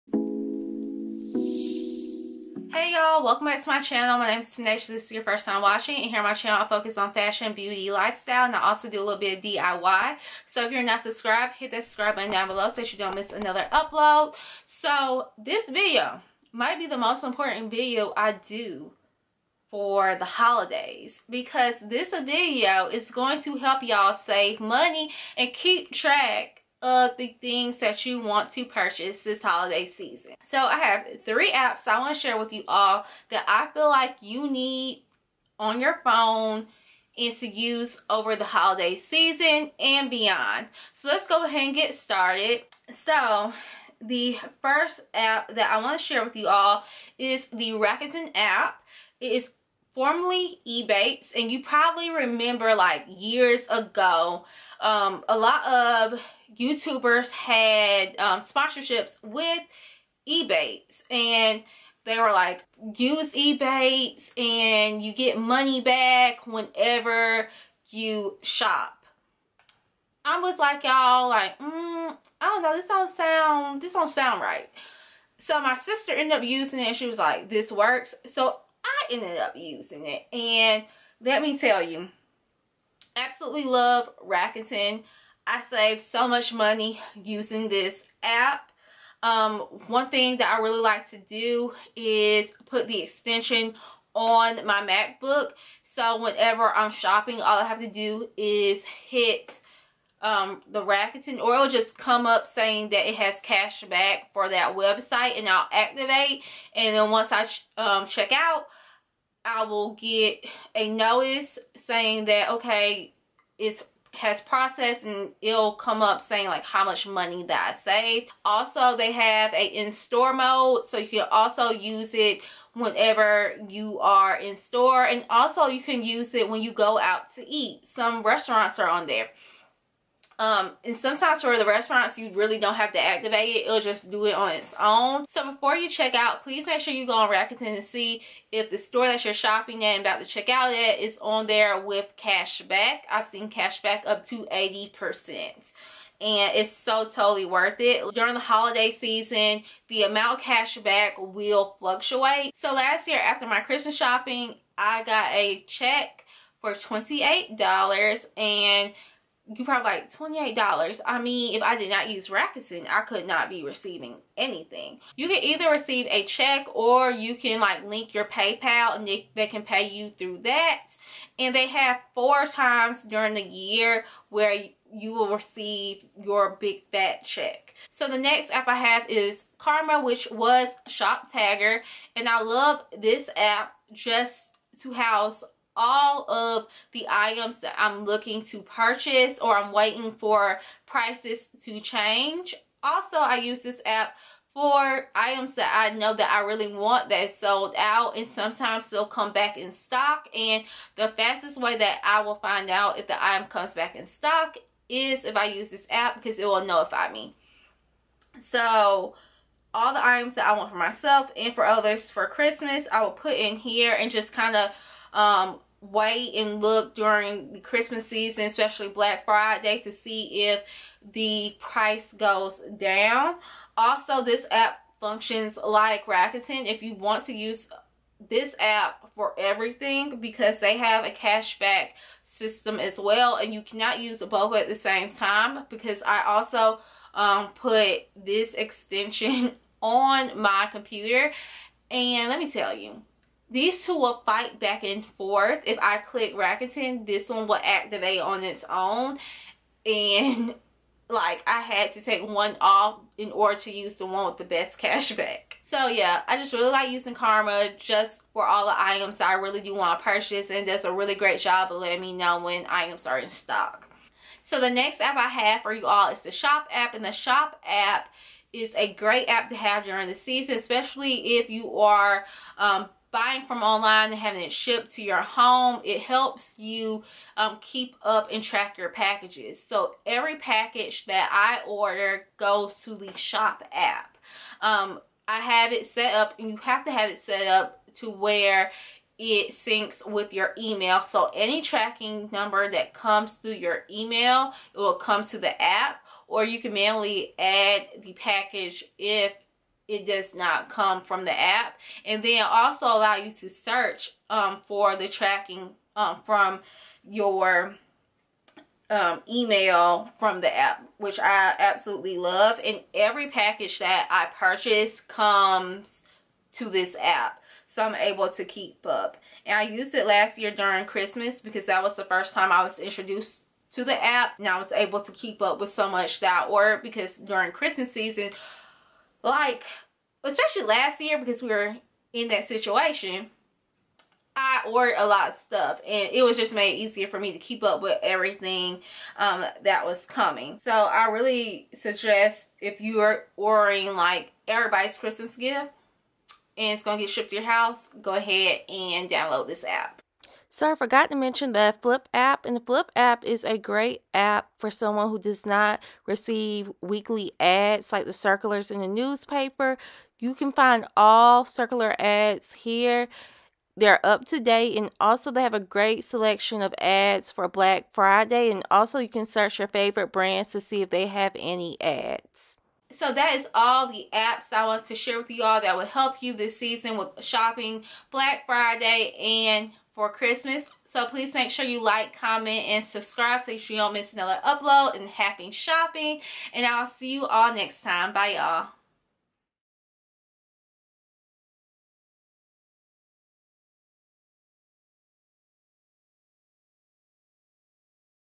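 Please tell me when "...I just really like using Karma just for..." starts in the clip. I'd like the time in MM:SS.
04:16.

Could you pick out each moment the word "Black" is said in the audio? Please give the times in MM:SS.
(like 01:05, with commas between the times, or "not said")
03:38, 06:07, 06:18.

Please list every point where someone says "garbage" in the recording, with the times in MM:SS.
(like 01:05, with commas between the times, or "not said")
not said.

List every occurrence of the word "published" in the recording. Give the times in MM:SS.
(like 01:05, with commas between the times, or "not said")
not said.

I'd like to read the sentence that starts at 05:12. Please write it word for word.
And every package that I purchase comes to this app.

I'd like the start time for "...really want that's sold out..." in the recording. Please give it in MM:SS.
03:16.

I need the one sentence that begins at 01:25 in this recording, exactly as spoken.
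I saved so much money using this app.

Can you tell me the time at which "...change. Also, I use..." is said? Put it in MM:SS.
03:11.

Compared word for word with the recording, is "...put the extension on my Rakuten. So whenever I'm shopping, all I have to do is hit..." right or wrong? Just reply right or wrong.
wrong.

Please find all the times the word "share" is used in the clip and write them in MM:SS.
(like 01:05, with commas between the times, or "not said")
00:32, 00:46, 06:14.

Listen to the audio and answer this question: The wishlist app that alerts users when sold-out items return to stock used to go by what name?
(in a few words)
Shoptagr.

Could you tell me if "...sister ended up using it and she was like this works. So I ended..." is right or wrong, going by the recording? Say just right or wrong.
right.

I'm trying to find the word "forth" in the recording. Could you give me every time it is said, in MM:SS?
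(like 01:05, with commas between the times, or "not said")
04:05.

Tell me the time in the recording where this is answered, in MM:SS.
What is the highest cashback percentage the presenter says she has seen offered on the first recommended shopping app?
02:24.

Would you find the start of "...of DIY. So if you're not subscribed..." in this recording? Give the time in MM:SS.
00:09.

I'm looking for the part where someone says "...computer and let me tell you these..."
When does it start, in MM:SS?
04:00.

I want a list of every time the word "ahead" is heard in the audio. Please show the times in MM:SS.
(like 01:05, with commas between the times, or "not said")
00:41, 05:48.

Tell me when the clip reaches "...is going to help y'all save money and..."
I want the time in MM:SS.
00:22.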